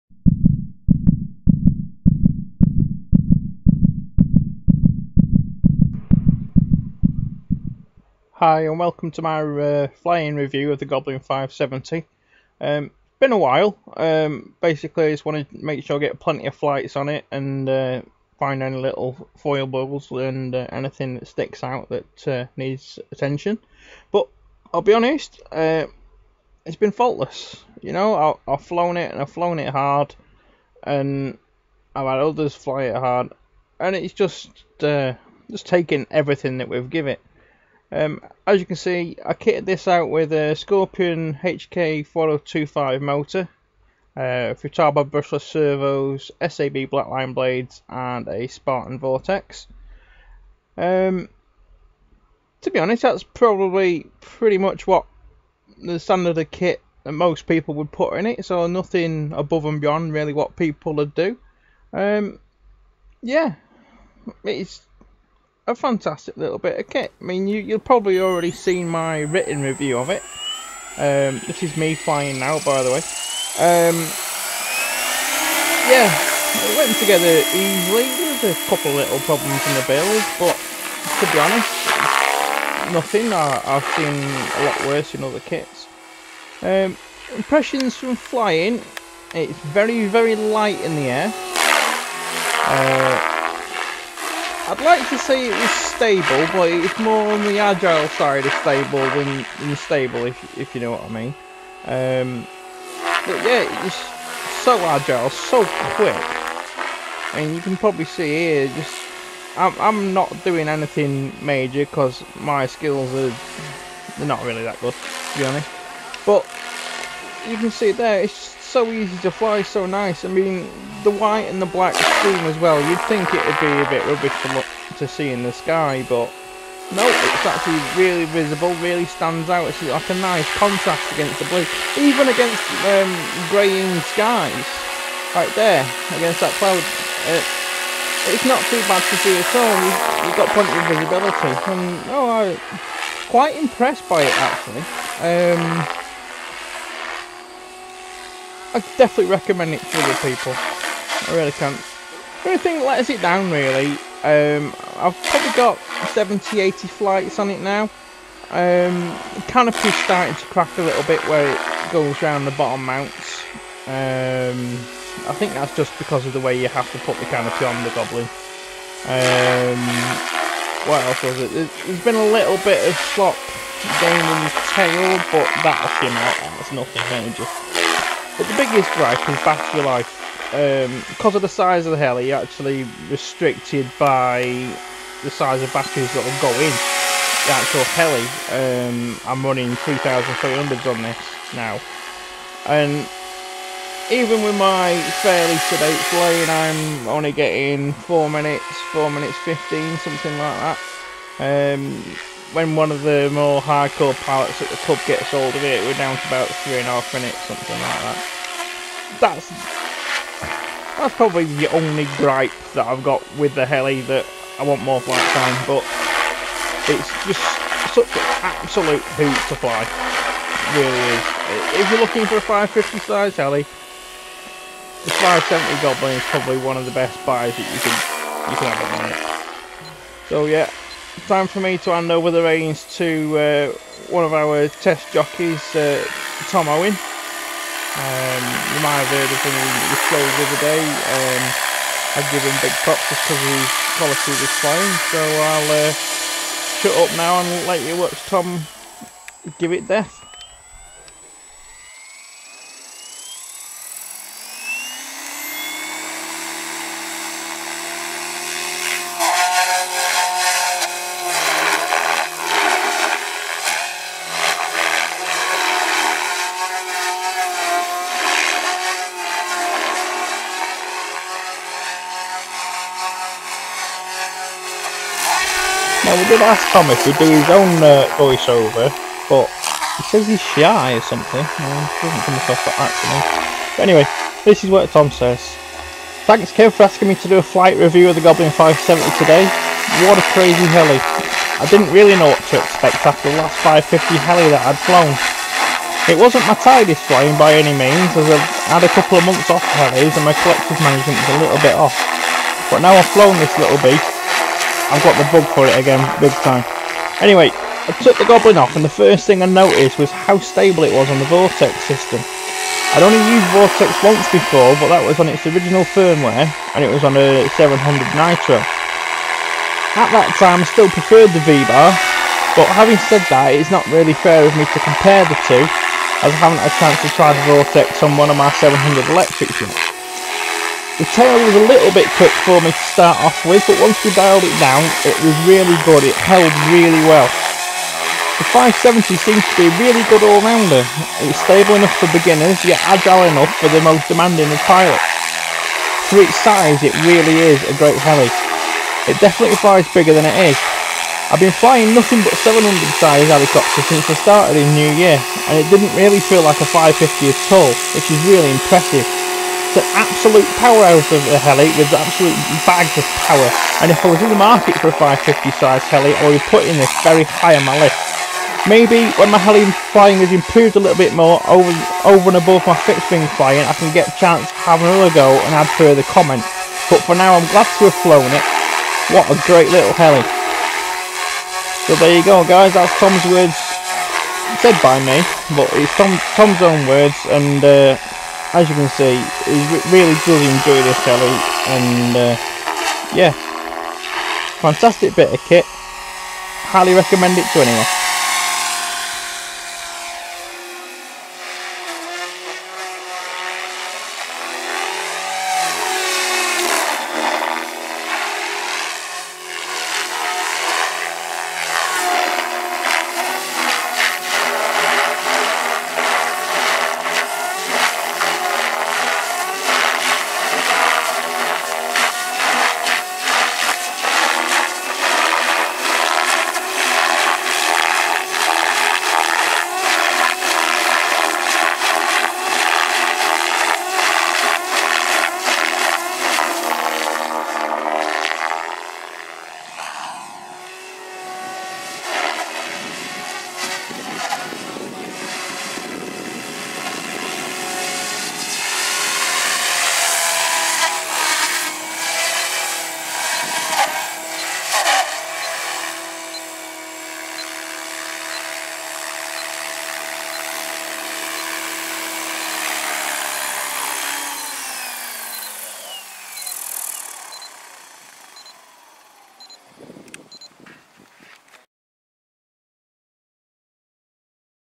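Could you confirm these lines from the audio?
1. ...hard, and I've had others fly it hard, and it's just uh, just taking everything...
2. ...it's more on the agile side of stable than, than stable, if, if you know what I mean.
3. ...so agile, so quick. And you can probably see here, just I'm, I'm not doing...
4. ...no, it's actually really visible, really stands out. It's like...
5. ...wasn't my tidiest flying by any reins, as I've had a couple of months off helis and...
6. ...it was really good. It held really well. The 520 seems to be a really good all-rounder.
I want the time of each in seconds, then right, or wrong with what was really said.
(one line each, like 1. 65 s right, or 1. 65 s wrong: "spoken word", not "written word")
1. 29 s right
2. 96 s right
3. 104 s right
4. 126 s right
5. 296 s wrong: "means", not "reins"
6. 335 s wrong: "570", not "520".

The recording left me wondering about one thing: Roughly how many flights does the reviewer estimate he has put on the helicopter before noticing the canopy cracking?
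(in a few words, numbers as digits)
70 to 80.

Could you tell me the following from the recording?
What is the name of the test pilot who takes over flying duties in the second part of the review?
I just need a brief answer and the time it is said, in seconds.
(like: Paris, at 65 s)
Tom Owen, at 236 s.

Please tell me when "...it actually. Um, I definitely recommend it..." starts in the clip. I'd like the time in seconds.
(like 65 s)
144 s.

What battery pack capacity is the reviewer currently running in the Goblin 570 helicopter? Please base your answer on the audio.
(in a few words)
3300s.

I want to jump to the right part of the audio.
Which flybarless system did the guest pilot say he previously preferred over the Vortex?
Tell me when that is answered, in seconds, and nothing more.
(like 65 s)
321 s.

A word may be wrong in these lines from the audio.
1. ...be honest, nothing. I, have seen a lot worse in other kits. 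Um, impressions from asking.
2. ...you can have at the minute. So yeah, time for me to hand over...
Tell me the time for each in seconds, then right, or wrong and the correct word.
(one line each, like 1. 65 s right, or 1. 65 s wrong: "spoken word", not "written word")
1. 81 s wrong: "flying", not "asking"
2. 228 s right.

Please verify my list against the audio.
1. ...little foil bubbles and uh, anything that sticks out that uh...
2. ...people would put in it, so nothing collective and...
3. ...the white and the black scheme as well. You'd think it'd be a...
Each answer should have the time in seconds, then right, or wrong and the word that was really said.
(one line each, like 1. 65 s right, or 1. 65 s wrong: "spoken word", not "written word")
1. 18 s right
2. 57 s wrong: "above", not "collective"
3. 121 s right.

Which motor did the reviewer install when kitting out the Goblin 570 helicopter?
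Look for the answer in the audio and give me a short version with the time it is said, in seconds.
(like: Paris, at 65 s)
Scorpion HK4025, at 40 s.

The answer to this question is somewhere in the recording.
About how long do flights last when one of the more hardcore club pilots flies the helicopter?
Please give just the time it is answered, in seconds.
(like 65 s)
206 s.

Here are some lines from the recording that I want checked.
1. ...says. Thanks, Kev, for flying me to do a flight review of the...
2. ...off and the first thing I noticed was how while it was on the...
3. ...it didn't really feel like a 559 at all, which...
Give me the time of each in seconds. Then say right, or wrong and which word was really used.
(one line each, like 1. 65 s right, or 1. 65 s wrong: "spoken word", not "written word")
1. 285 s wrong: "asking", not "flying"
2. 308 s wrong: "stable", not "while"
3. 355 s wrong: "550", not "559".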